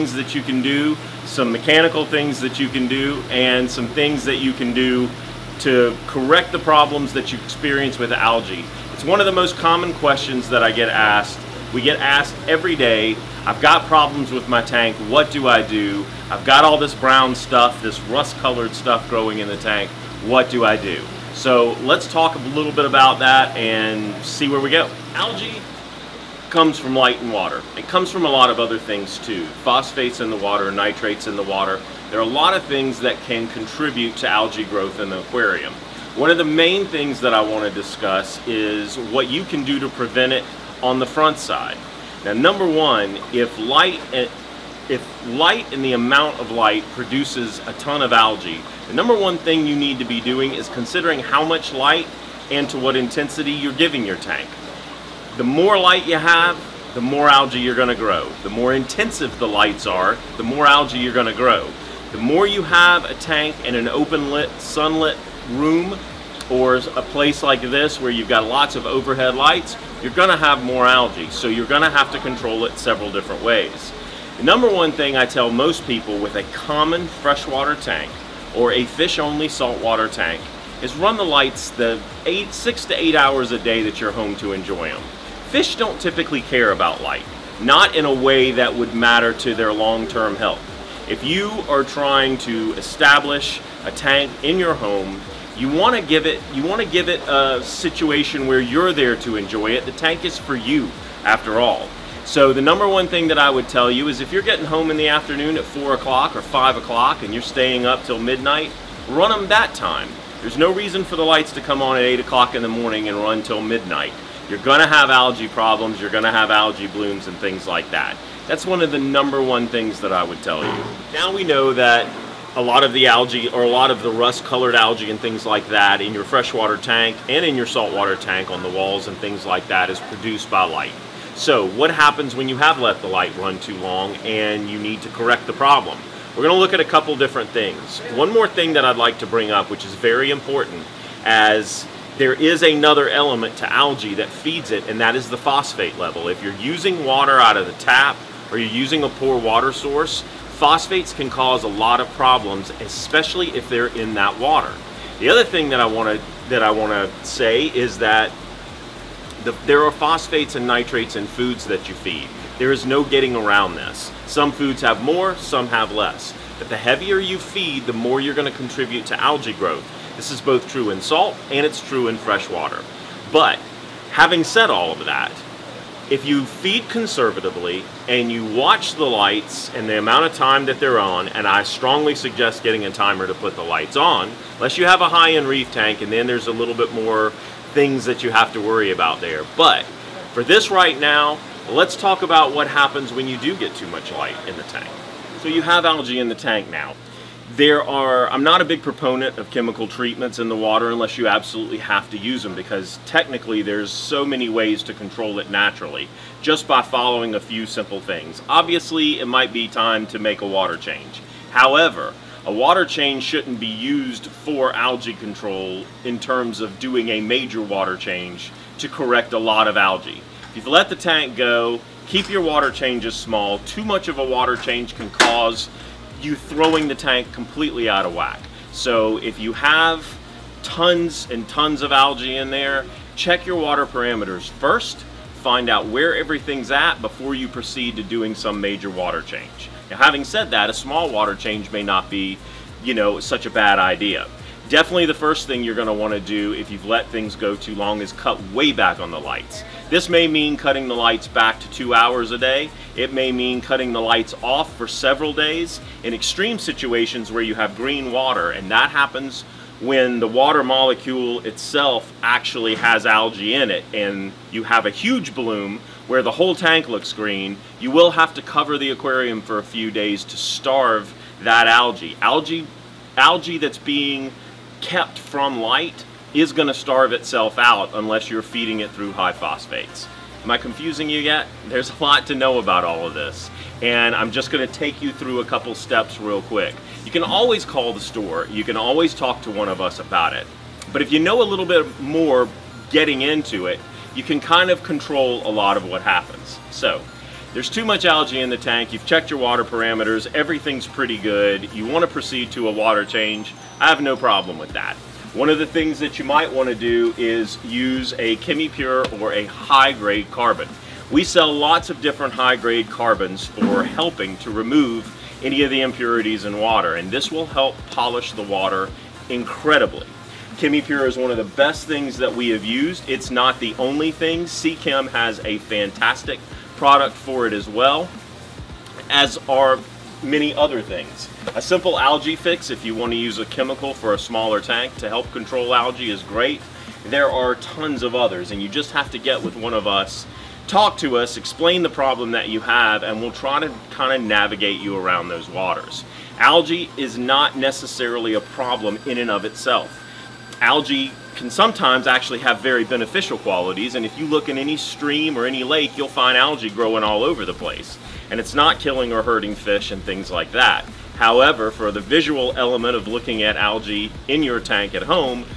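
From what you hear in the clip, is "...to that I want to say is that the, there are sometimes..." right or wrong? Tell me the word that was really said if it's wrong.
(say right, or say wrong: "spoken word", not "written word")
wrong: "phosphates", not "sometimes".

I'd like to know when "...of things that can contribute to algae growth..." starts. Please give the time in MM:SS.
00:32.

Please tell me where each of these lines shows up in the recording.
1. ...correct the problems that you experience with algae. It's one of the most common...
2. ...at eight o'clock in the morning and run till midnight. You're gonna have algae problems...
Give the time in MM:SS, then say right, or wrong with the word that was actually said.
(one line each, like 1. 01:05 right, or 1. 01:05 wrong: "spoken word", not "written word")
1. 00:06 right
2. 01:51 right.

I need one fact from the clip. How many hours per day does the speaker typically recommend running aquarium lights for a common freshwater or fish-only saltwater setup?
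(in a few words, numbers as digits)
6 to 8 hours.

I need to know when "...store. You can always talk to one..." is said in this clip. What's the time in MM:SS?
04:47.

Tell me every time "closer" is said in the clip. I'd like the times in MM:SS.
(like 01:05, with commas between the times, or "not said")
not said.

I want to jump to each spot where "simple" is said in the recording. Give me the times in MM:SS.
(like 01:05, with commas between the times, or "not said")
03:27, 05:31.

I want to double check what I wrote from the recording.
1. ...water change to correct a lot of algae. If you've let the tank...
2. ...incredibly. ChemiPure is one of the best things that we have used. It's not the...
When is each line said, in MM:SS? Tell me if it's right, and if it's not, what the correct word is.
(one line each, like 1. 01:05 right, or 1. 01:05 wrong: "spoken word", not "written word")
1. 03:37 right
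2. 05:19 right.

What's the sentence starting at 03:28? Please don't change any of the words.
Obviously, it might be time to make a water change.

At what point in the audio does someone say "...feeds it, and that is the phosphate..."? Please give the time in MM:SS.
02:24.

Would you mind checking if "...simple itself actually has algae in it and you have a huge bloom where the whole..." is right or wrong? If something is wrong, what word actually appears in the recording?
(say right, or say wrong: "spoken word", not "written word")
wrong: "molecule", not "simple".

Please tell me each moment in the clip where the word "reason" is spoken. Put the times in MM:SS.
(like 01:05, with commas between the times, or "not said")
01:50.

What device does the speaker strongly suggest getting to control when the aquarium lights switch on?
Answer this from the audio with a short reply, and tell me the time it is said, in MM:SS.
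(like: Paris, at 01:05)
A timer, at 03:02.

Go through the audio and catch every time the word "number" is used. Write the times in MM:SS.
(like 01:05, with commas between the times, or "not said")
00:42, 00:48, 01:14, 01:42, 01:58.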